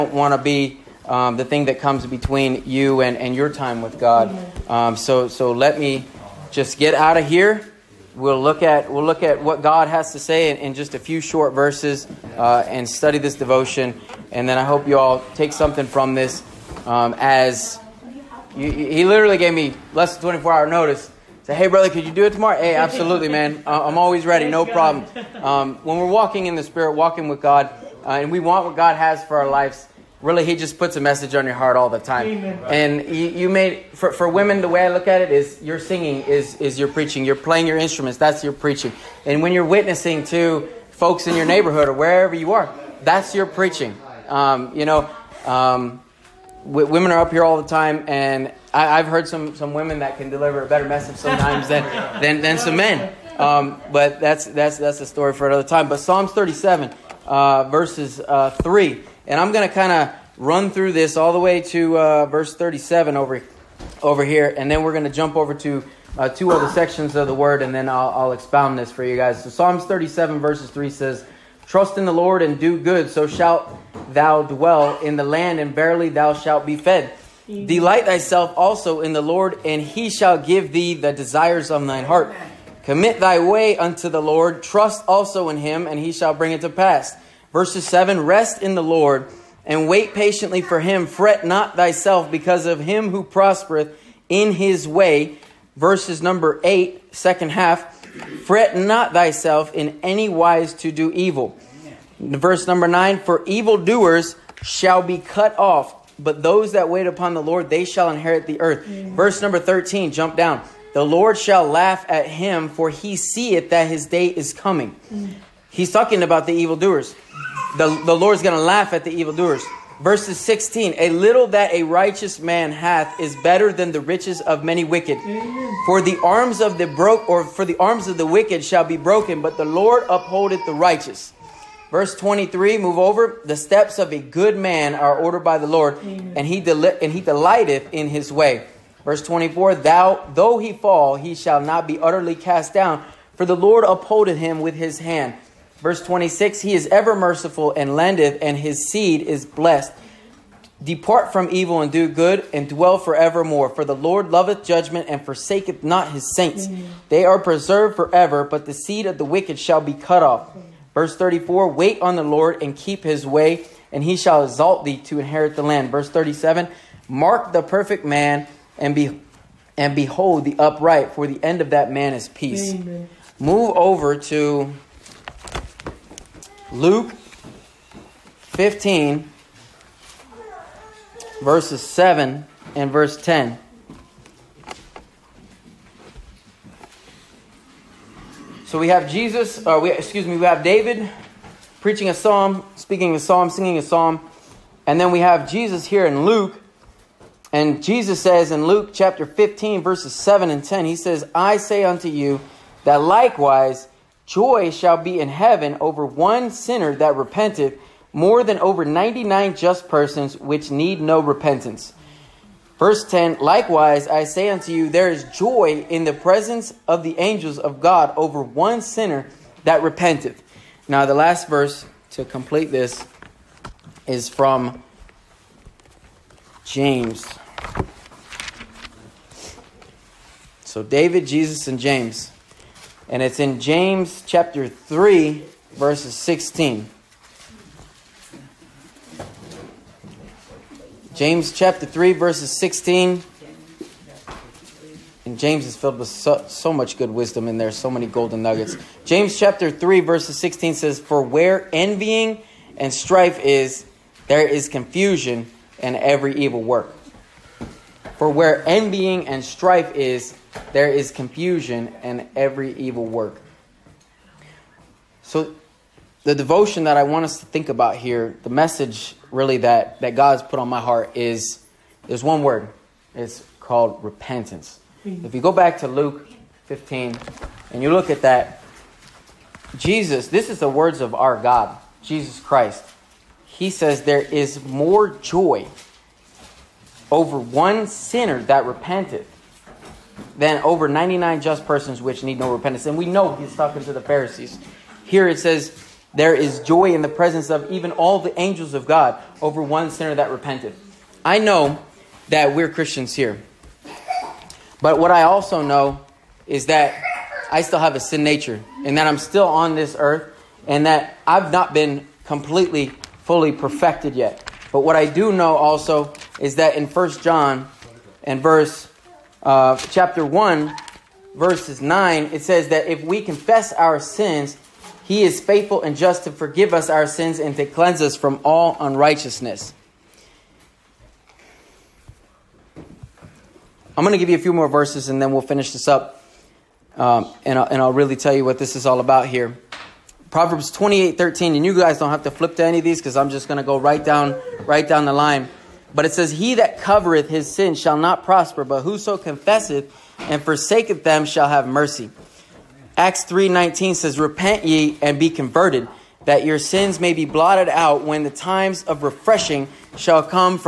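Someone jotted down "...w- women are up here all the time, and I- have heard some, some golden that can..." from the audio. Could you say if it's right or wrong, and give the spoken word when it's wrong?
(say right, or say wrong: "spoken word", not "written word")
wrong: "women", not "golden".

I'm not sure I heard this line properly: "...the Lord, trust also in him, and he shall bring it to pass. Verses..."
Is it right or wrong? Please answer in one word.
right.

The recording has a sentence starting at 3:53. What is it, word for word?
And it's in James chapter 3, verses 16.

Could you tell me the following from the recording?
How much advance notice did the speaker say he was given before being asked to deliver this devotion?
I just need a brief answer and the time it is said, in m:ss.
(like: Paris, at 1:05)
Less than 24 hours, at 0:19.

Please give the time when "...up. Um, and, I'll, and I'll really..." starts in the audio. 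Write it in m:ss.
5:35.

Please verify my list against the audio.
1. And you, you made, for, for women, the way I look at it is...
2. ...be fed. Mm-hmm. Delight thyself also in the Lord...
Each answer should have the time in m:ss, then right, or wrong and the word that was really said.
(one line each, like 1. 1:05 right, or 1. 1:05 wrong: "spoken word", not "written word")
1. 0:32 right
2. 1:16 right.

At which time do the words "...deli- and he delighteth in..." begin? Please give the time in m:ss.
2:16.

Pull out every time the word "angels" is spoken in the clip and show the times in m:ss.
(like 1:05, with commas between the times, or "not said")
3:37, 4:58.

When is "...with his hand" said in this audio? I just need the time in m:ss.
2:24.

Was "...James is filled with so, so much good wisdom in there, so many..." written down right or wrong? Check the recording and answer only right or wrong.
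right.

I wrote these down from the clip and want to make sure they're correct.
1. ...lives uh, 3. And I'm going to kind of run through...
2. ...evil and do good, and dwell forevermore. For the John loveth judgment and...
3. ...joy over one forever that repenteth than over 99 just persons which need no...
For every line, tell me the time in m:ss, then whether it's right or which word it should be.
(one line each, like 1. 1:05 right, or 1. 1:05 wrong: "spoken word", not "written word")
1. 0:57 wrong: "verses", not "lives"
2. 2:31 wrong: "Lord", not "John"
3. 4:45 wrong: "sinner", not "forever".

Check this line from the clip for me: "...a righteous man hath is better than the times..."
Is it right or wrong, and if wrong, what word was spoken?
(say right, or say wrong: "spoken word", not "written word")
wrong: "riches", not "times".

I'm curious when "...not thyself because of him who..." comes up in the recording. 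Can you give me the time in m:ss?
1:31.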